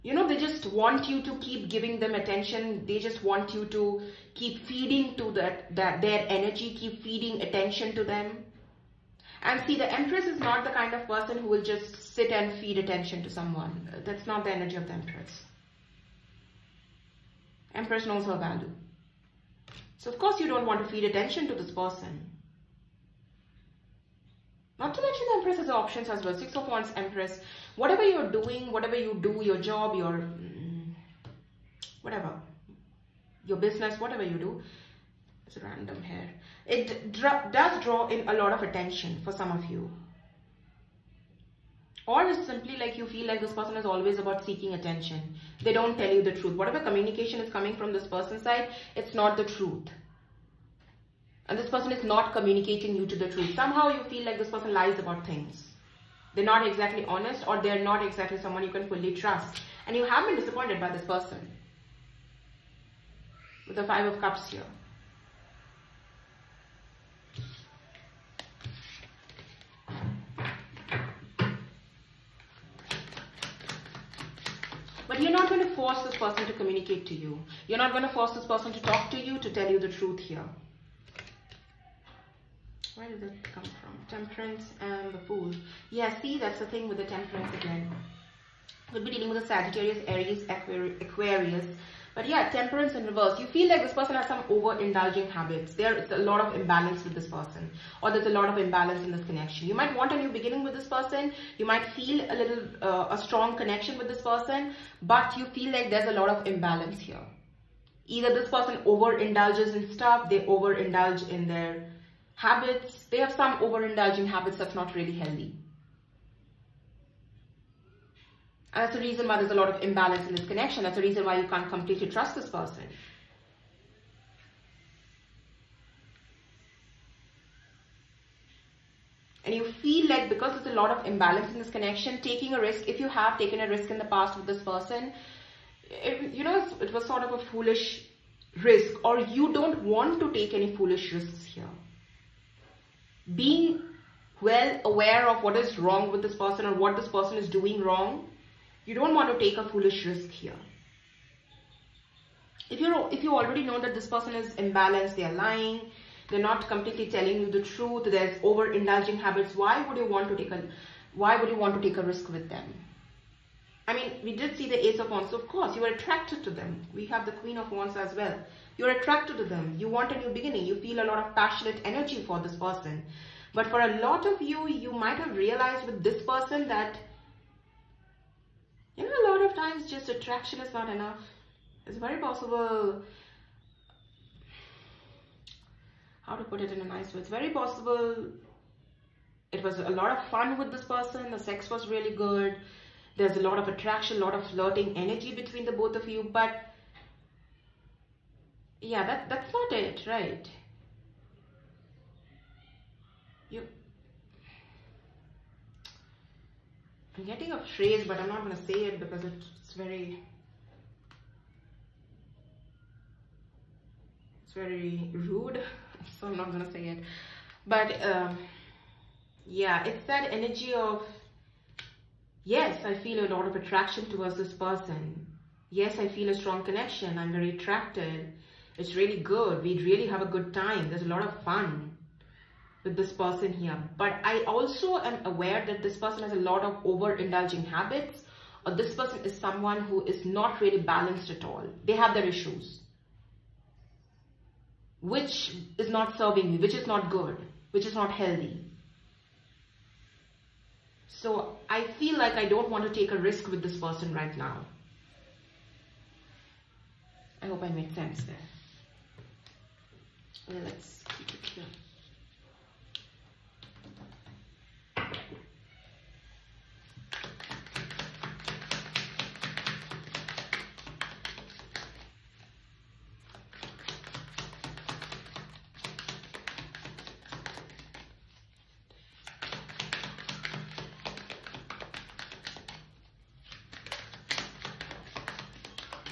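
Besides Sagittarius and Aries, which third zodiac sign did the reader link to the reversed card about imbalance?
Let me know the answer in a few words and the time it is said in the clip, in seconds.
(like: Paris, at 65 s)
Aquarius, at 90 s.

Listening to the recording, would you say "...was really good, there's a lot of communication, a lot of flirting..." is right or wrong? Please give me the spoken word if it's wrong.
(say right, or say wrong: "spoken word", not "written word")
wrong: "attraction", not "communication".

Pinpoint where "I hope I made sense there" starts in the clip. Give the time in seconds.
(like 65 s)
257 s.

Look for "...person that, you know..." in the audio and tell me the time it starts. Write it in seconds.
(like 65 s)
176 s.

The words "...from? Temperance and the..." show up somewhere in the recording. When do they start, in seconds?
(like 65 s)
83 s.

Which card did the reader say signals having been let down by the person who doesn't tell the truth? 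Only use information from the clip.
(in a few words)
Five of Cups.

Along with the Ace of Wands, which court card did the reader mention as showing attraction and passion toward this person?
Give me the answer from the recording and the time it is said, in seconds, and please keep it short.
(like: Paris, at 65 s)
Queen of Wands, at 167 s.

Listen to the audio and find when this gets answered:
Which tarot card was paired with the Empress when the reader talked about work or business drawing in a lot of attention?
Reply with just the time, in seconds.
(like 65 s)
26 s.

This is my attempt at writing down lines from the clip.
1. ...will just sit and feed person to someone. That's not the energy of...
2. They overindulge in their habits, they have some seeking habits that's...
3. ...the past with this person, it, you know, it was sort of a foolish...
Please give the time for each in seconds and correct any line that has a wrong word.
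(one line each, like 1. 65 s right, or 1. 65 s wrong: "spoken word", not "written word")
1. 11 s wrong: "attention", not "person"
2. 110 s wrong: "overindulging", not "seeking"
3. 133 s right.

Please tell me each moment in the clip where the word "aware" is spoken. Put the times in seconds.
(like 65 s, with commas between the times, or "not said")
144 s, 235 s.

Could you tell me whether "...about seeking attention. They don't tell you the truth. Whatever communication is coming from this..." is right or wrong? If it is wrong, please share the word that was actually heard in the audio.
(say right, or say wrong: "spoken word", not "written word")
right.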